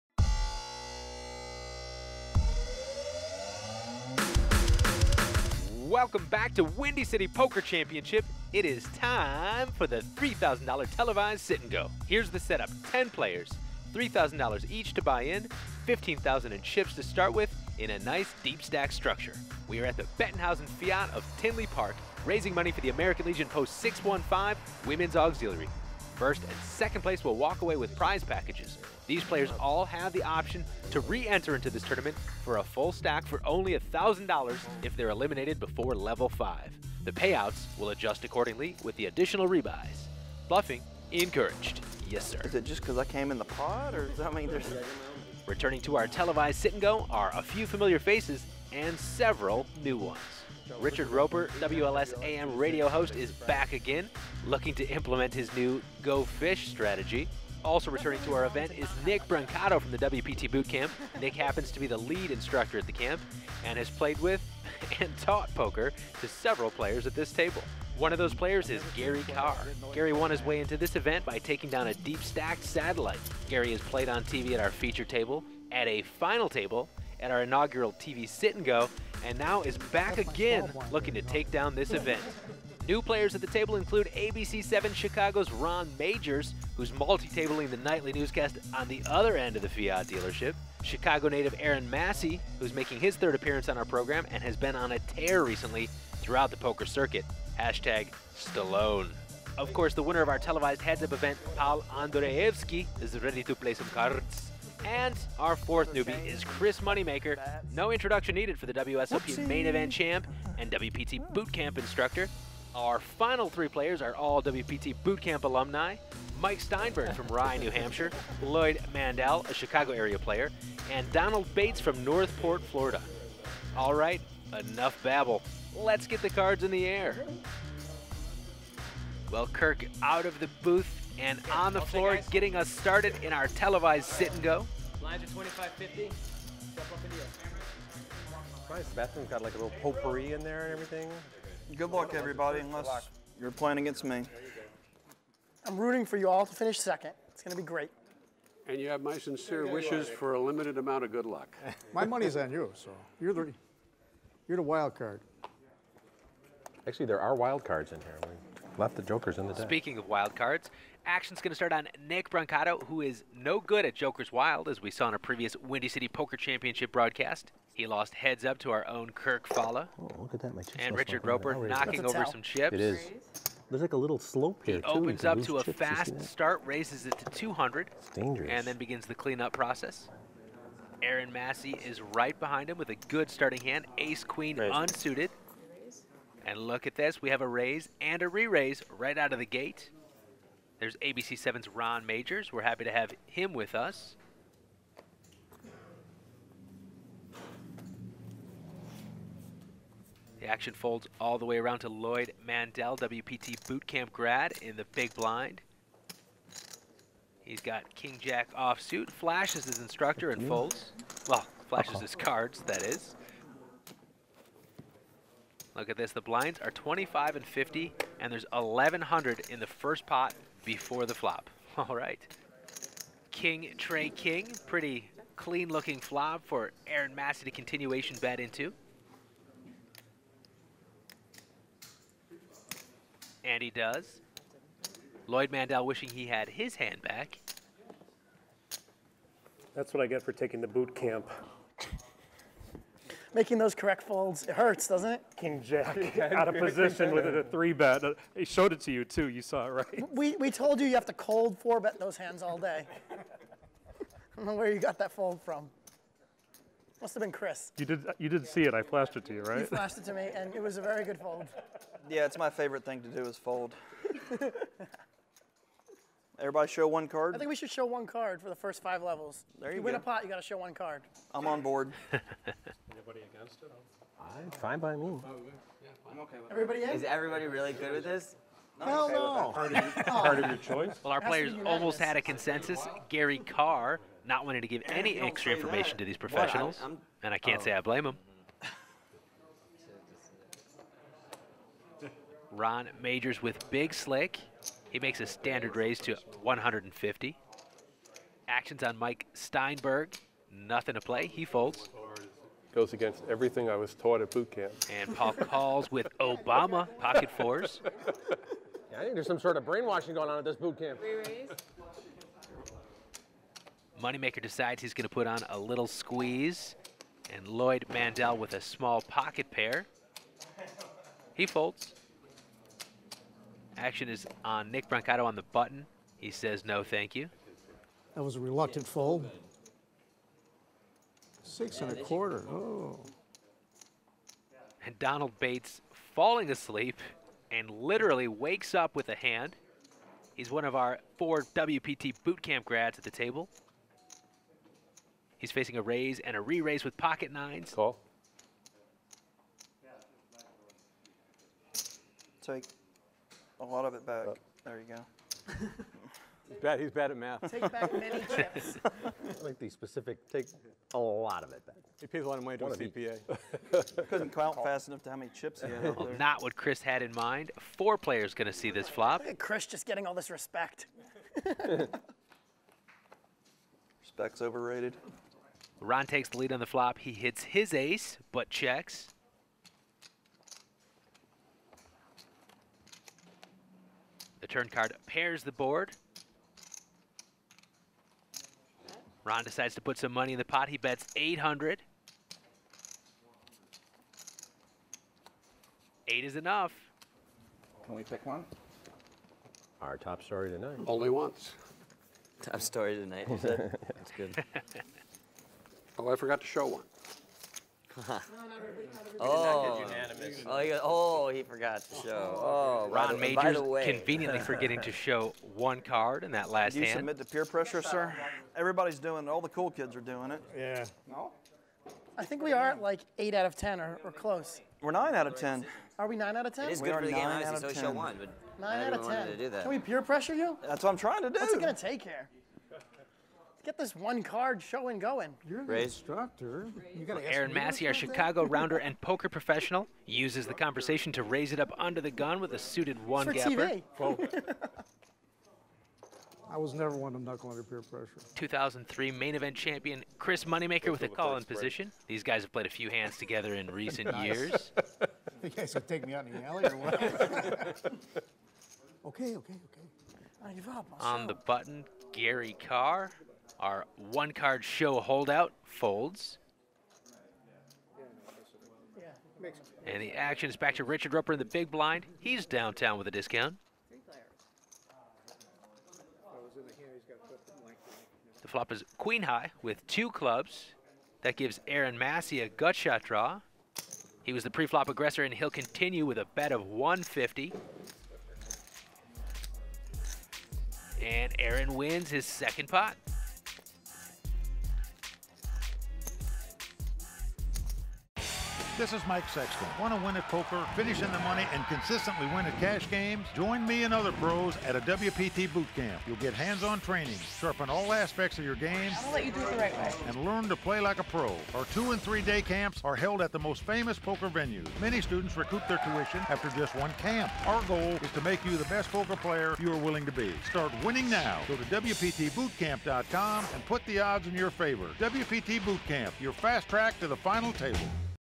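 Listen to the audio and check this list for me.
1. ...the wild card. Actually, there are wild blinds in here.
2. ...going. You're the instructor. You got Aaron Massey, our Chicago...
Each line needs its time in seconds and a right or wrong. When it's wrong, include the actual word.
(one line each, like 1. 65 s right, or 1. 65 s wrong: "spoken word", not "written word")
1. 154 s wrong: "cards", not "blinds"
2. 434 s right.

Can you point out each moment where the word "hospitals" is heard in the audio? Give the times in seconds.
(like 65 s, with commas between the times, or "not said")
not said.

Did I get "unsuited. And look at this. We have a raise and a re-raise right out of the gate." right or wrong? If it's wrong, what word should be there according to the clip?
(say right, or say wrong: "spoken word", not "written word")
right.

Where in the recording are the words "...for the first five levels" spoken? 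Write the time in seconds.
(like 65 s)
268 s.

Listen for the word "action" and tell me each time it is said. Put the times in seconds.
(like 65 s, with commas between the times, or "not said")
161 s, 200 s, 298 s, 323 s, 470 s.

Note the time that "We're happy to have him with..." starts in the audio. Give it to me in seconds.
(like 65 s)
192 s.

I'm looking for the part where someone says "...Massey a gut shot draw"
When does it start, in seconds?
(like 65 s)
481 s.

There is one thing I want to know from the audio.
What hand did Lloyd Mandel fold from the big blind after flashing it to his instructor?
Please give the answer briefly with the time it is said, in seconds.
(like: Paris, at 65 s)
King Jack offsuit, at 207 s.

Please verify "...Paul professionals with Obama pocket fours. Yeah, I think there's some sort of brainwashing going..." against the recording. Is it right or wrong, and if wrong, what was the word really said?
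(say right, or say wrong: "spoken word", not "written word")
wrong: "calls", not "professionals".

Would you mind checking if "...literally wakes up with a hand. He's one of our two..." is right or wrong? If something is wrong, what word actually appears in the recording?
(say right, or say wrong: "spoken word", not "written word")
wrong: "four", not "two".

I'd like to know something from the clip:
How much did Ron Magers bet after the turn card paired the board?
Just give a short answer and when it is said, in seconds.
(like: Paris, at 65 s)
800, at 390 s.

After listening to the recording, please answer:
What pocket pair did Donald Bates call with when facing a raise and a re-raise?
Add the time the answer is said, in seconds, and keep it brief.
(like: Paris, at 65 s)
pocket nines, at 346 s.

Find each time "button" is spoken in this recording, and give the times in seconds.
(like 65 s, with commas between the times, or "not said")
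325 s, 461 s.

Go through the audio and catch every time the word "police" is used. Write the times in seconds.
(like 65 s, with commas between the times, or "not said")
not said.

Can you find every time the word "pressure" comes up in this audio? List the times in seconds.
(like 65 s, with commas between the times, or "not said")
417 s, 430 s, 447 s.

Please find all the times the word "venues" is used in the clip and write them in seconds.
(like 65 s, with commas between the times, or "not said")
514 s.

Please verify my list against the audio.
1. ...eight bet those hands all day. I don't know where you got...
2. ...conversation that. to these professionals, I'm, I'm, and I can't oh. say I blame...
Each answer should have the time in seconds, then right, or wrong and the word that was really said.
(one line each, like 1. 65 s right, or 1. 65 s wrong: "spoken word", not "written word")
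1. 251 s wrong: "four", not "eight"
2. 285 s wrong: "information", not "conversation".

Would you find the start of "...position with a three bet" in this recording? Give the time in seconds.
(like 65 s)
246 s.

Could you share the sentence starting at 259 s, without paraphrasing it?
You flashed it to me, and it was a very good fold.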